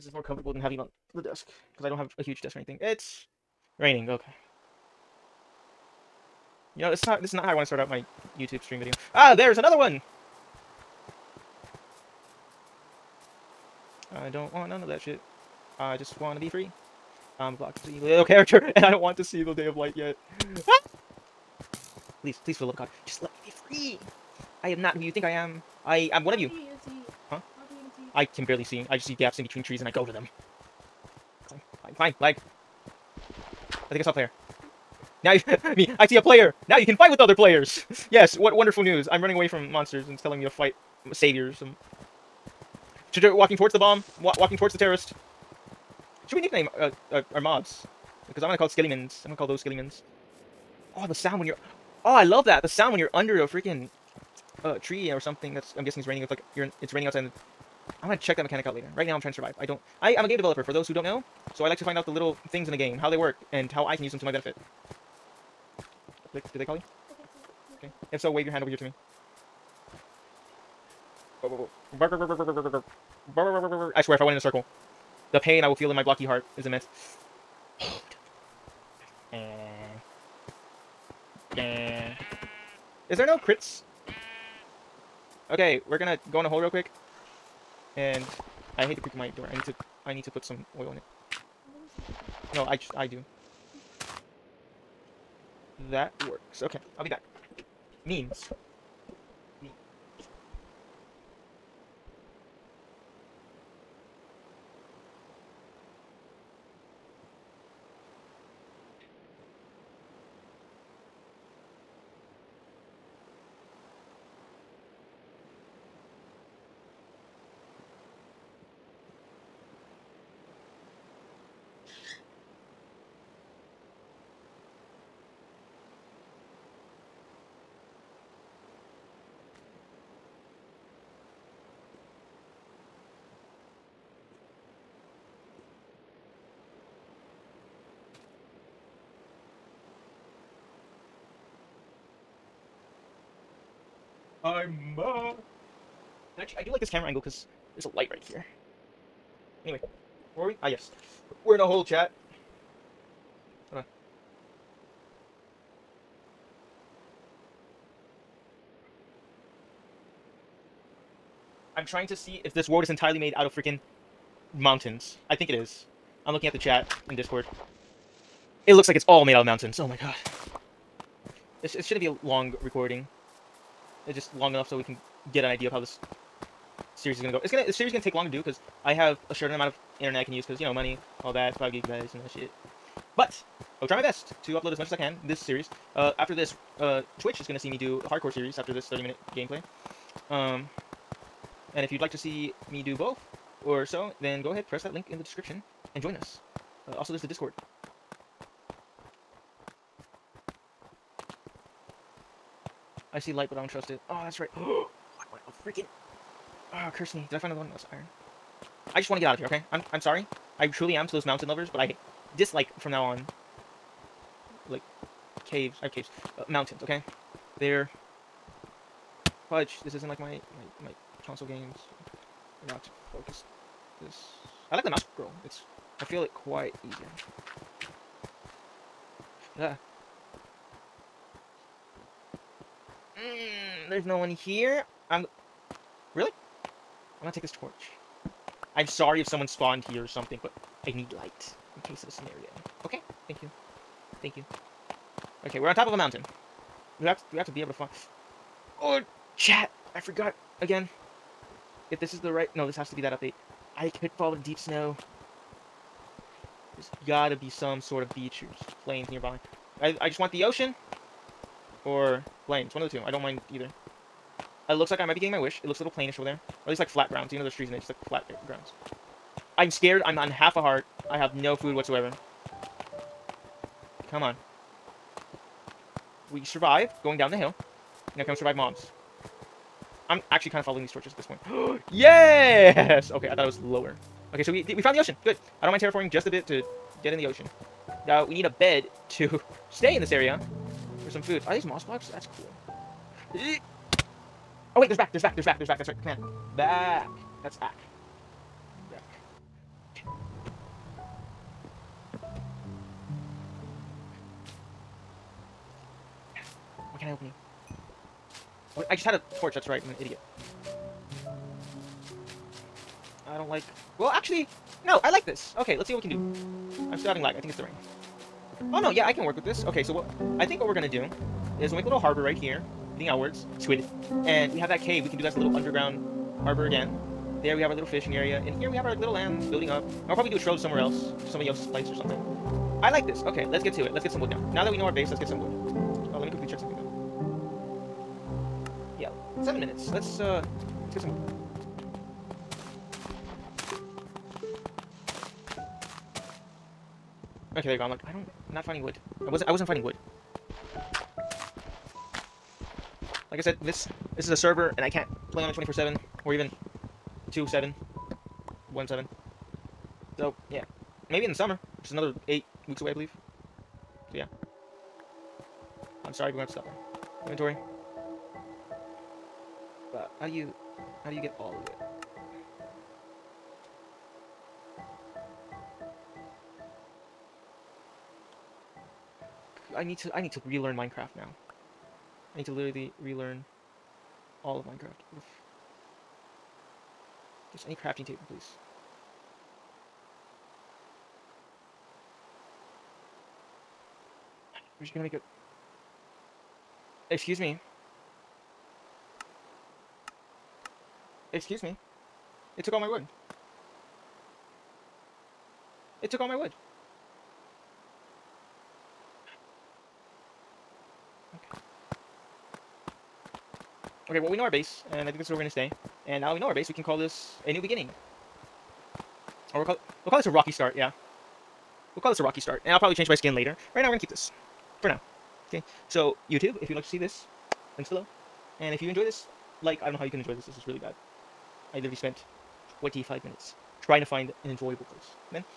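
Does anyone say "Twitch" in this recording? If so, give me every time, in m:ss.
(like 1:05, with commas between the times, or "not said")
3:07.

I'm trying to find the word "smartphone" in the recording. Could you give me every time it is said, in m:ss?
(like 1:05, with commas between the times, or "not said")
not said.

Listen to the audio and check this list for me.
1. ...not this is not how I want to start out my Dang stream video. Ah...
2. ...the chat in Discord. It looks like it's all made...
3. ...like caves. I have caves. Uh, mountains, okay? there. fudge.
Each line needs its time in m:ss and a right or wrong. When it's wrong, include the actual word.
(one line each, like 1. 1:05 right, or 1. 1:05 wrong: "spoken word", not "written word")
1. 0:07 wrong: "YouTube", not "Dang"
2. 2:46 right
3. 3:34 right.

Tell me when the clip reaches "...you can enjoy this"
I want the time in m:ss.
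7:10.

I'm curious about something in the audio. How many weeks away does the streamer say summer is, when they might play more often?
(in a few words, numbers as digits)
8.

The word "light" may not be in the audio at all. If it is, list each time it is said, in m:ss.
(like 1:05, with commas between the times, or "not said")
0:19, 2:27, 3:23, 4:01.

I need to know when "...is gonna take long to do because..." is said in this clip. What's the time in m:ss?
2:57.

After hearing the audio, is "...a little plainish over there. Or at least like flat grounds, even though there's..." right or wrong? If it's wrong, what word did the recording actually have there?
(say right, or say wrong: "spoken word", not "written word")
right.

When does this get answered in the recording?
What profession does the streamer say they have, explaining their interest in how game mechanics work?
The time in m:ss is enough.
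1:00.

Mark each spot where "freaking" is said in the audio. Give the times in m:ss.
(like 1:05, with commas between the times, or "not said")
0:53, 2:43, 3:25.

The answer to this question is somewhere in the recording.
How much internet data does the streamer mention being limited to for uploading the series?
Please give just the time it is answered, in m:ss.
3:01.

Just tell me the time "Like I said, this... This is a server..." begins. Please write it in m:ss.
5:53.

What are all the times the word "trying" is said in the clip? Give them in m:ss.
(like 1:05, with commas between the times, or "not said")
0:59, 2:41, 7:13.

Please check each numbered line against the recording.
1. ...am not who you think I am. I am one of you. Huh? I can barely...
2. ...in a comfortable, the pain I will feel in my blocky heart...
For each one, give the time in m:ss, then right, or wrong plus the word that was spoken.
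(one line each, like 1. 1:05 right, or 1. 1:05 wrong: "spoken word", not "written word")
1. 0:24 right
2. 1:14 wrong: "circle", not "comfortable".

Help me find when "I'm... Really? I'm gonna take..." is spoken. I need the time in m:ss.
3:55.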